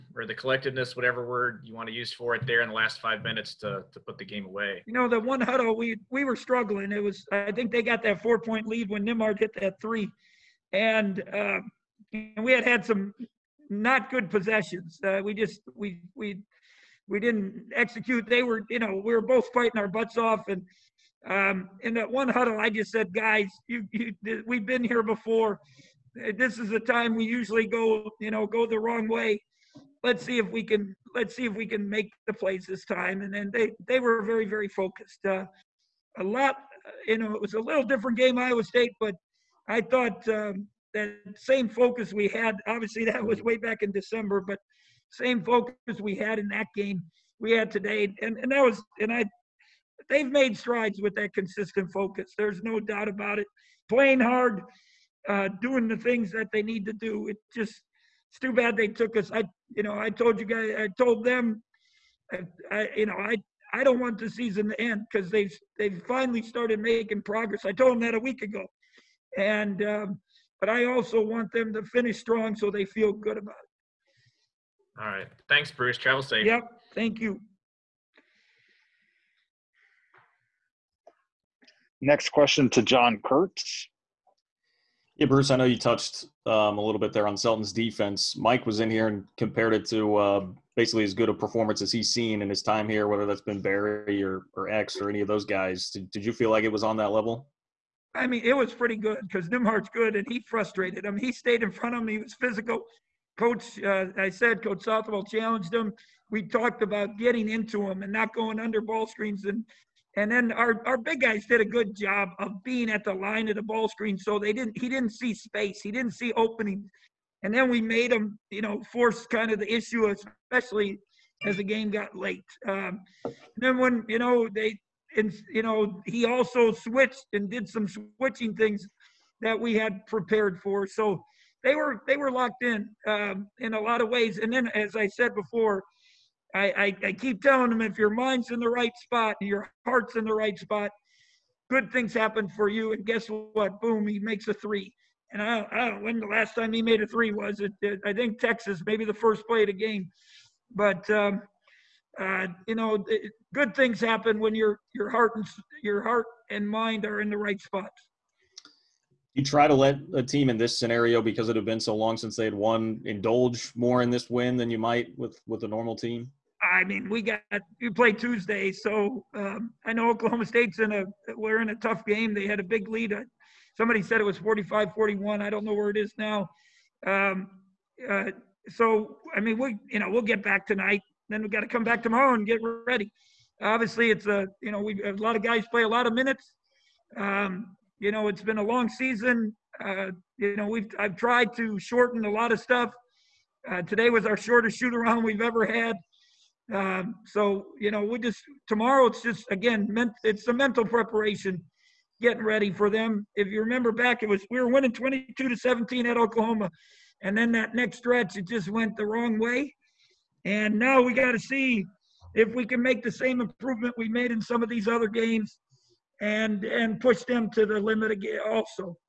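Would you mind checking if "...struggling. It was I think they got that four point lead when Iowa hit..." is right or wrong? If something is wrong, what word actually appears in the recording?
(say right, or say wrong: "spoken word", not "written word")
wrong: "Nembhard", not "Iowa".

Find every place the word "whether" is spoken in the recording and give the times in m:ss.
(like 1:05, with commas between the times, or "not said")
1:33.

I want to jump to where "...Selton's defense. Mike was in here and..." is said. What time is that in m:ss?
1:27.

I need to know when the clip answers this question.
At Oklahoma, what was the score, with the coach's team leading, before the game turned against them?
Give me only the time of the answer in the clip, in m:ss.
3:24.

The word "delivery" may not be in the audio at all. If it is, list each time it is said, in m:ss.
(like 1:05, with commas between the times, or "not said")
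not said.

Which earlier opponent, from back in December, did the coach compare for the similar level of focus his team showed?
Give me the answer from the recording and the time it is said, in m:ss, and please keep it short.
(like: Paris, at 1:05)
Iowa State, at 0:38.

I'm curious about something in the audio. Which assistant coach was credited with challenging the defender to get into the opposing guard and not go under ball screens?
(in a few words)
Coach Southwell.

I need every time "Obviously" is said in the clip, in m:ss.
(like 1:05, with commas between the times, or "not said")
0:42, 3:03.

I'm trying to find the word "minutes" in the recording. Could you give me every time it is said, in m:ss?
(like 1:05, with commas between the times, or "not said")
0:03, 3:06.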